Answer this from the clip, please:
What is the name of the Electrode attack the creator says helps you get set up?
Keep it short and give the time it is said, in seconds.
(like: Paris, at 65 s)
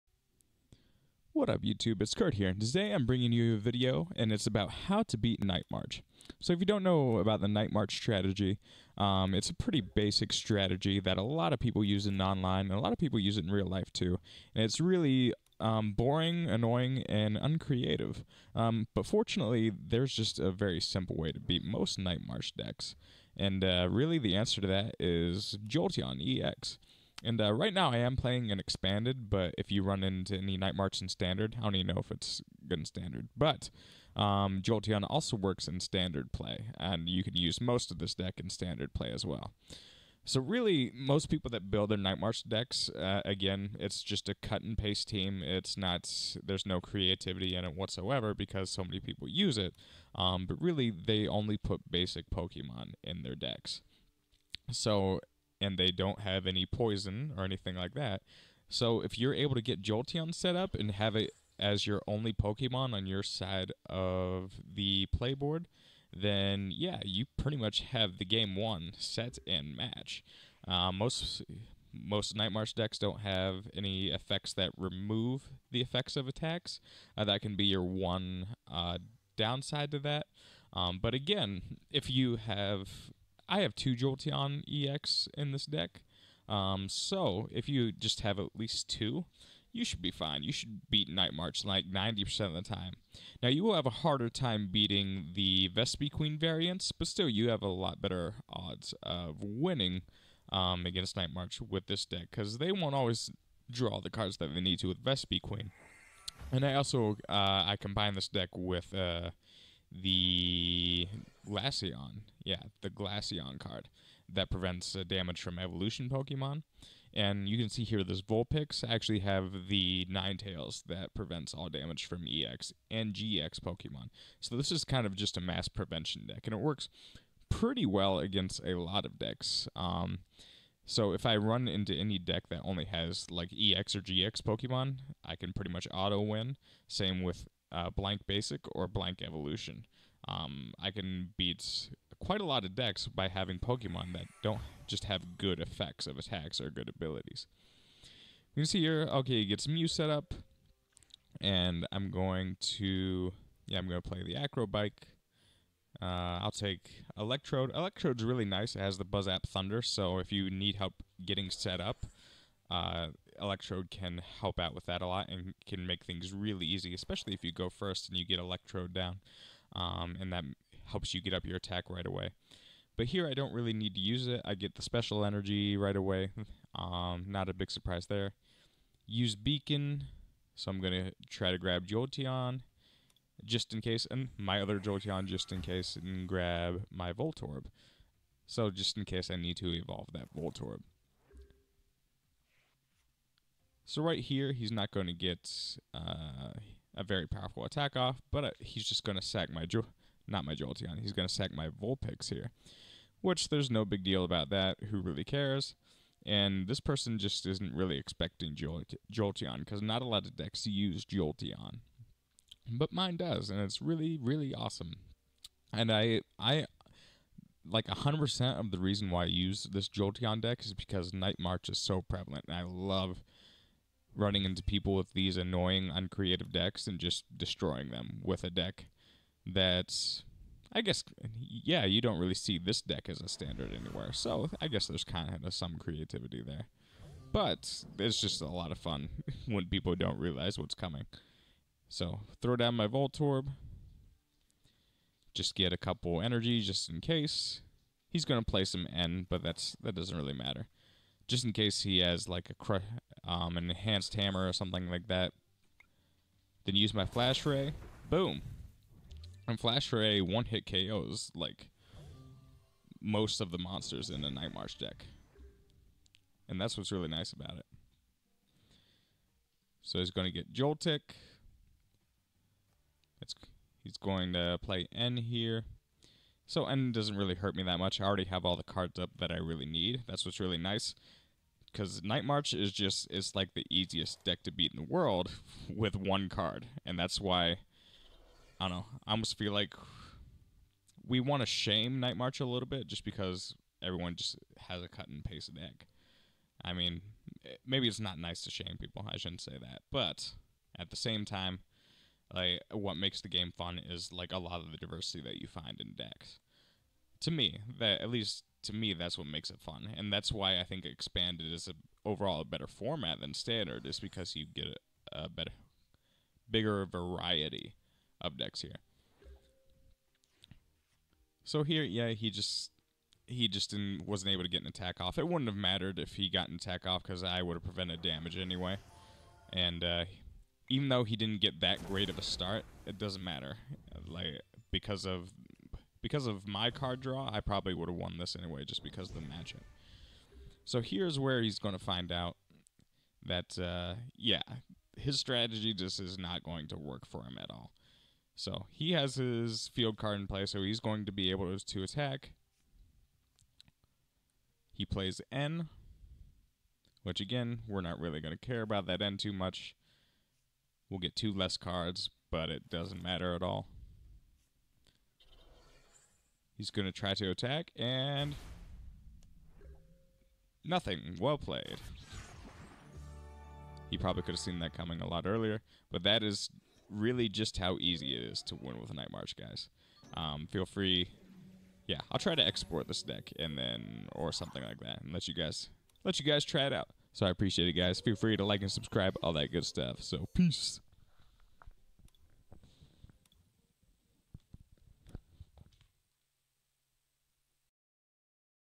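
Buzzap Thunder, at 159 s.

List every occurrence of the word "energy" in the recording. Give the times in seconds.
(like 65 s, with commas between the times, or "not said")
175 s, 246 s.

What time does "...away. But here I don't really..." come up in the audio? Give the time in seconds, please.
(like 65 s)
172 s.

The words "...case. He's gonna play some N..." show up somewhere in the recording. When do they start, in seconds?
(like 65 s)
246 s.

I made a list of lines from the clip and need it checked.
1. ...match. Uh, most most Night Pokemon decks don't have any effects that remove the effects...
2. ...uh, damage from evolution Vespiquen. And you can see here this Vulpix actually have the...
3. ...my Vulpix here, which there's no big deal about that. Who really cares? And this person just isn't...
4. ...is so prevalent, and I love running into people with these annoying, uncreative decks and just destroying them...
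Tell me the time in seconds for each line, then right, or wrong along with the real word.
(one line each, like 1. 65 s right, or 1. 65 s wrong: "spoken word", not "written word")
1. 69 s wrong: "March", not "Pokemon"
2. 114 s wrong: "Pokemon", not "Vespiquen"
3. 201 s right
4. 221 s right.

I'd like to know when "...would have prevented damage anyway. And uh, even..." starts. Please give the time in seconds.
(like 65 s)
327 s.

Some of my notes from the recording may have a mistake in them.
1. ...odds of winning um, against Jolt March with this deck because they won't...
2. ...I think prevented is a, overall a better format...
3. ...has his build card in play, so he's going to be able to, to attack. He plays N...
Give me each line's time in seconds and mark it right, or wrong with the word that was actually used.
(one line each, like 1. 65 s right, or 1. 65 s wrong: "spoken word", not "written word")
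1. 98 s wrong: "Night", not "Jolt"
2. 310 s wrong: "expanded", not "prevented"
3. 348 s wrong: "field", not "build".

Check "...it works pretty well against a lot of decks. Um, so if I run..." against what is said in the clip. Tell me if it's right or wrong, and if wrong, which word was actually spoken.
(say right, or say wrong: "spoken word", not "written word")
right.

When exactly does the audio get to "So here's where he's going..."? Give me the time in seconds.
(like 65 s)
340 s.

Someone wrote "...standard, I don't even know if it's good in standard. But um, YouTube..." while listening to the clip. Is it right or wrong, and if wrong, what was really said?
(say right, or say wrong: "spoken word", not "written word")
wrong: "Jolteon", not "YouTube".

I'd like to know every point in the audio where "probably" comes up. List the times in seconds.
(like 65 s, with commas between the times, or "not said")
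337 s, 373 s.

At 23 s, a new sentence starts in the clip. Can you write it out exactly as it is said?
And uh, really the answer to that is Jolteon EX.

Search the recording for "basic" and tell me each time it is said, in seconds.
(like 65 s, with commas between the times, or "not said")
9 s, 51 s, 138 s.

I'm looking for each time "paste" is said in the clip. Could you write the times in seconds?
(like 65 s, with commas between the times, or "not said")
44 s, 295 s.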